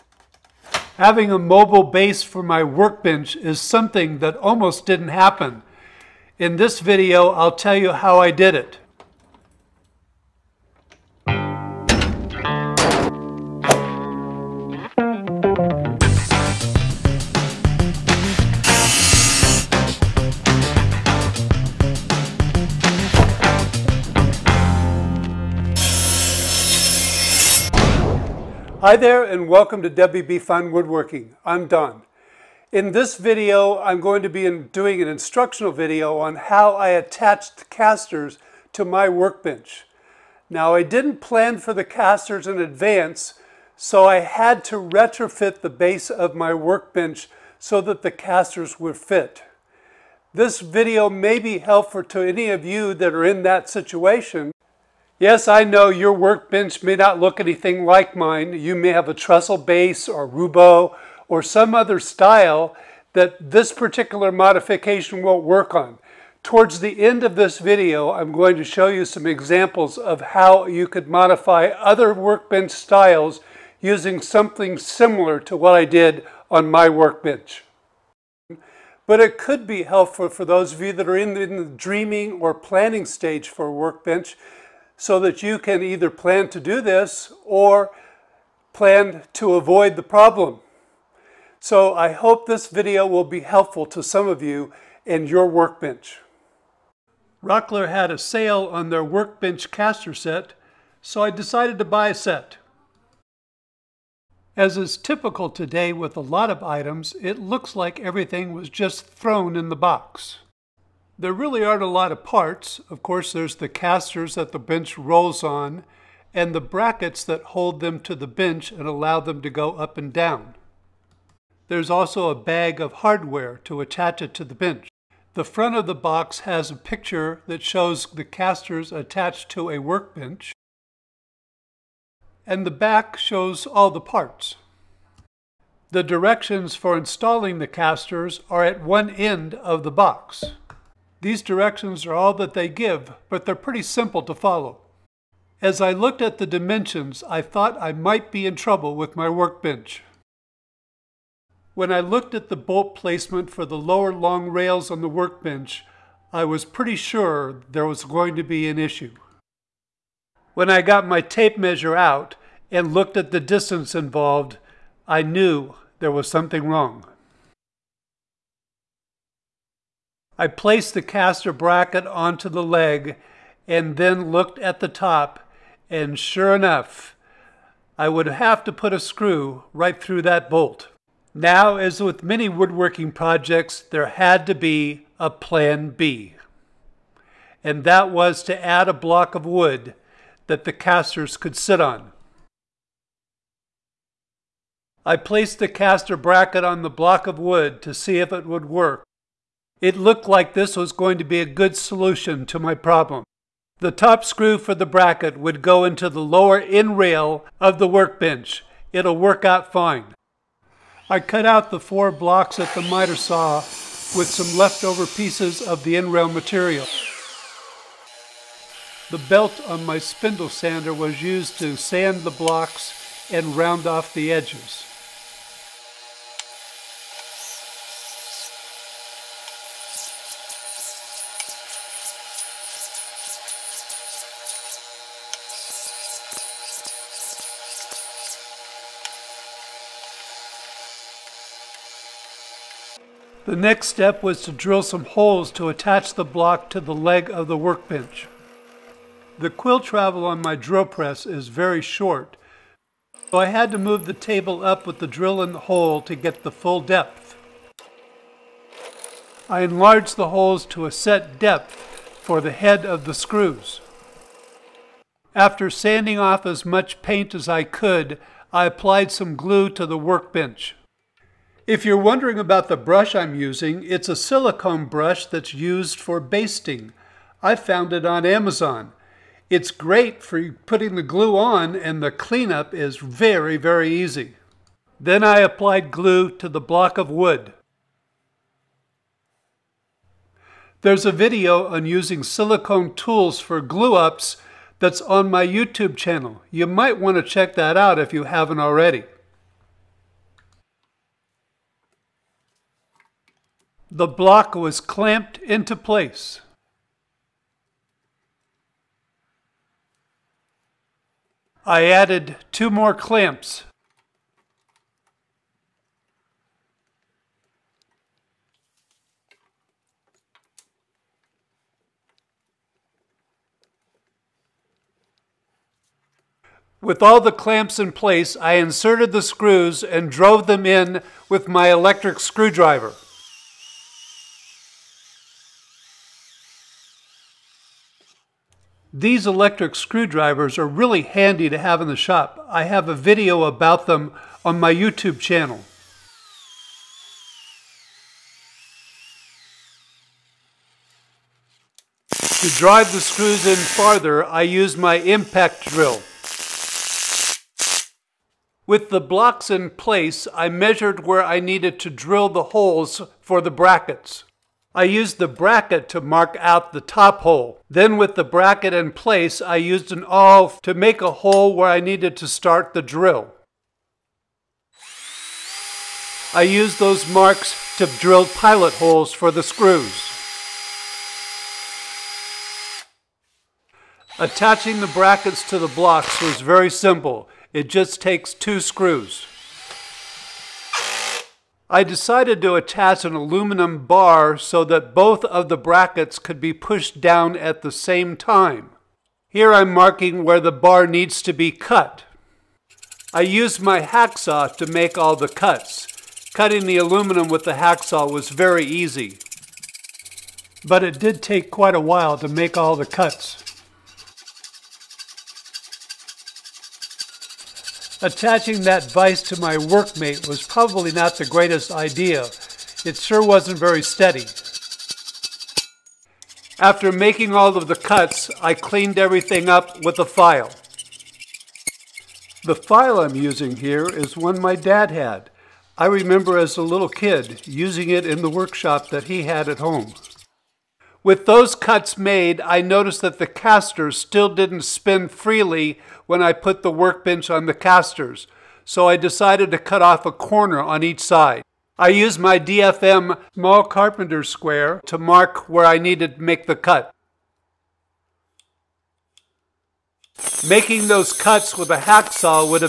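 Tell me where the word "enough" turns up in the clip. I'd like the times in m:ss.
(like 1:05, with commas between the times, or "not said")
2:56.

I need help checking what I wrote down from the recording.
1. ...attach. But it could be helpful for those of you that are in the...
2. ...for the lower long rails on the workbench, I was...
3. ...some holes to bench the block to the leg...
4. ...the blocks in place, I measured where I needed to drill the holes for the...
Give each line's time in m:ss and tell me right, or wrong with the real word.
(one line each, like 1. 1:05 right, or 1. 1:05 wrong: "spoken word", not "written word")
1. 1:16 wrong: "workbench", not "attach"
2. 2:33 right
3. 4:04 wrong: "attach", not "bench"
4. 5:58 right.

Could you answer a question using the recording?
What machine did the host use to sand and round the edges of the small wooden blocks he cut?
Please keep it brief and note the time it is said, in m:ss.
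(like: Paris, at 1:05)
spindle sander, at 3:39.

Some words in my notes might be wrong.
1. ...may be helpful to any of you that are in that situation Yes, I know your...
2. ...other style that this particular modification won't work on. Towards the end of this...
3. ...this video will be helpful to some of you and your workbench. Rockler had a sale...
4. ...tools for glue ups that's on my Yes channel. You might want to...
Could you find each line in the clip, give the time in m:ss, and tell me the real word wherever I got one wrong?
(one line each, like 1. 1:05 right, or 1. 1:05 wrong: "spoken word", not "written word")
1. 0:51 right
2. 1:01 right
3. 1:32 right
4. 4:52 wrong: "YouTube", not "Yes".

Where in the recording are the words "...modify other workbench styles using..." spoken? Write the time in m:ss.
1:11.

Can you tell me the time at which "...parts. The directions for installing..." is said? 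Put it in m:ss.
2:14.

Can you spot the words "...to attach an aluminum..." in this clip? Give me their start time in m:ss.
6:32.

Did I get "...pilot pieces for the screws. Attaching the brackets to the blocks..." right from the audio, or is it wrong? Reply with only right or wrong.
wrong.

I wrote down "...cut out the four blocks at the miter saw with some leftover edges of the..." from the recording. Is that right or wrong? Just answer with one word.
wrong.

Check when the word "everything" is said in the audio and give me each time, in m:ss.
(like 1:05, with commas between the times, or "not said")
1:47, 7:08.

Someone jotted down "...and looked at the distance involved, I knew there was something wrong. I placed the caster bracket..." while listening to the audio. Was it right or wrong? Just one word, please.
right.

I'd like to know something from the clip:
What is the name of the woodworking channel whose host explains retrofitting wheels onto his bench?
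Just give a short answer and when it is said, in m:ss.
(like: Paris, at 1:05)
WB Fine Woodworking, at 0:29.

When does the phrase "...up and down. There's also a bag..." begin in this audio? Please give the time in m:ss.
1:59.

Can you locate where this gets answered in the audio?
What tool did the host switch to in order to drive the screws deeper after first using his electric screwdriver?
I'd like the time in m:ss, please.
5:54.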